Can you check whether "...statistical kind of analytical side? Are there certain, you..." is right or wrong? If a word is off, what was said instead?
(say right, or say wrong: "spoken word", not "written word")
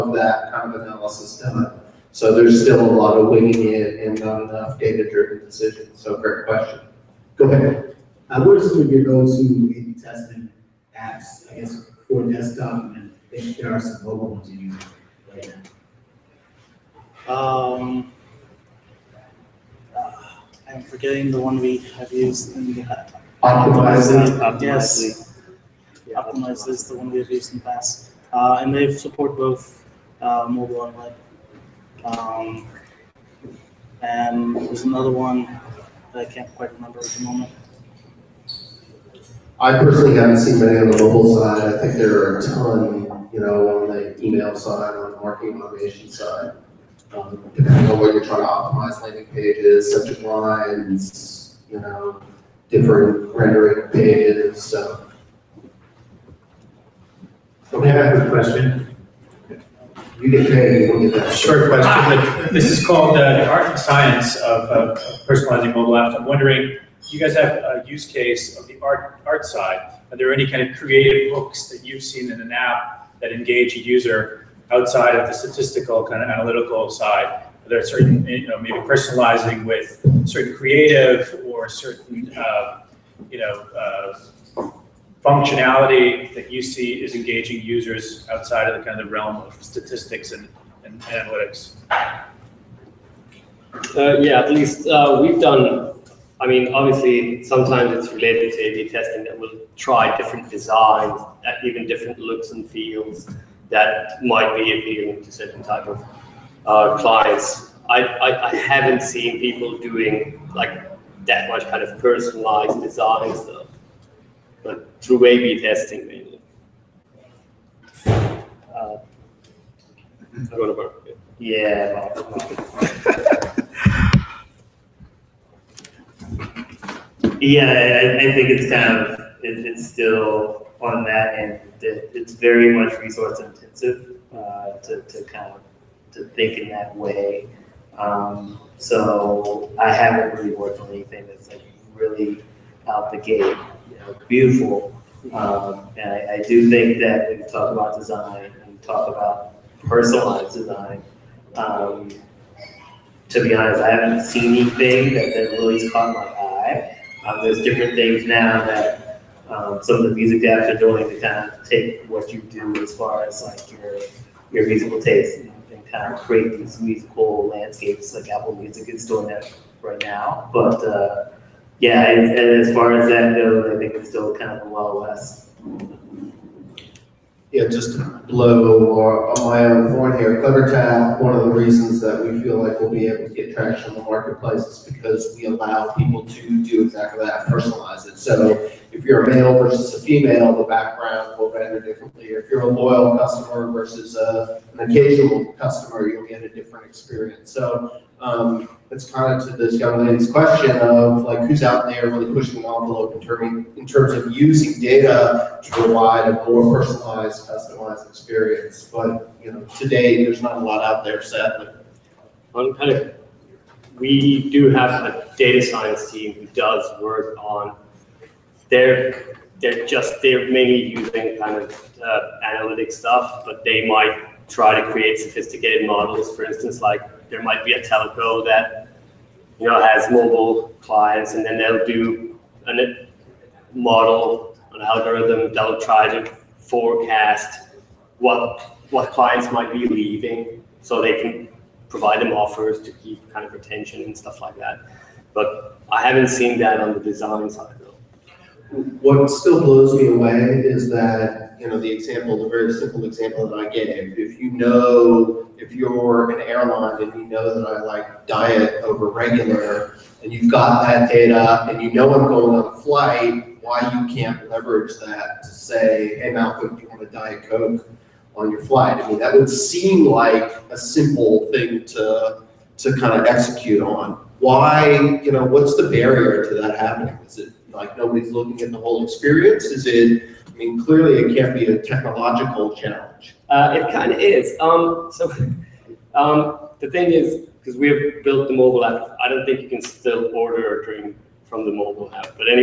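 right.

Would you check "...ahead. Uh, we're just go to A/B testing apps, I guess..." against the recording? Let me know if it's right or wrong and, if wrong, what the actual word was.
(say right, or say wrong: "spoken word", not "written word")
right.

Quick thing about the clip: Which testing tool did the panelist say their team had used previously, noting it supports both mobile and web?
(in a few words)
Optimizely.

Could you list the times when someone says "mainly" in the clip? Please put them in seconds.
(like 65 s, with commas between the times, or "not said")
116 s, 220 s.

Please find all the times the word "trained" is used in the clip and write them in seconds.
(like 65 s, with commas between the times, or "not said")
not said.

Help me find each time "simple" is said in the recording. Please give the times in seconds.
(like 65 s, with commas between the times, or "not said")
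252 s, 270 s.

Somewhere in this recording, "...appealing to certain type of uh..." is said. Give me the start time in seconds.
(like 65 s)
104 s.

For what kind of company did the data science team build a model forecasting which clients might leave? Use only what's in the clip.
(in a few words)
a telco.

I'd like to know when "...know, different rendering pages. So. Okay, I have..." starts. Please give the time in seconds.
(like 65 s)
51 s.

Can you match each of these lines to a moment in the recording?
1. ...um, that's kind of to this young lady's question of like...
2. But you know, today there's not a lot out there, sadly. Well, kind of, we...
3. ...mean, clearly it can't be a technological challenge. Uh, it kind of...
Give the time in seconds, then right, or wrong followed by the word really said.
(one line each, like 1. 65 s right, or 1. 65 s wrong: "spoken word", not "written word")
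1. 198 s right
2. 208 s right
3. 280 s right.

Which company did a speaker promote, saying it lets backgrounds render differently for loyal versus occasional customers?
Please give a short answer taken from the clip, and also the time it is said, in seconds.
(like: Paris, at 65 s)
CleverTap, at 180 s.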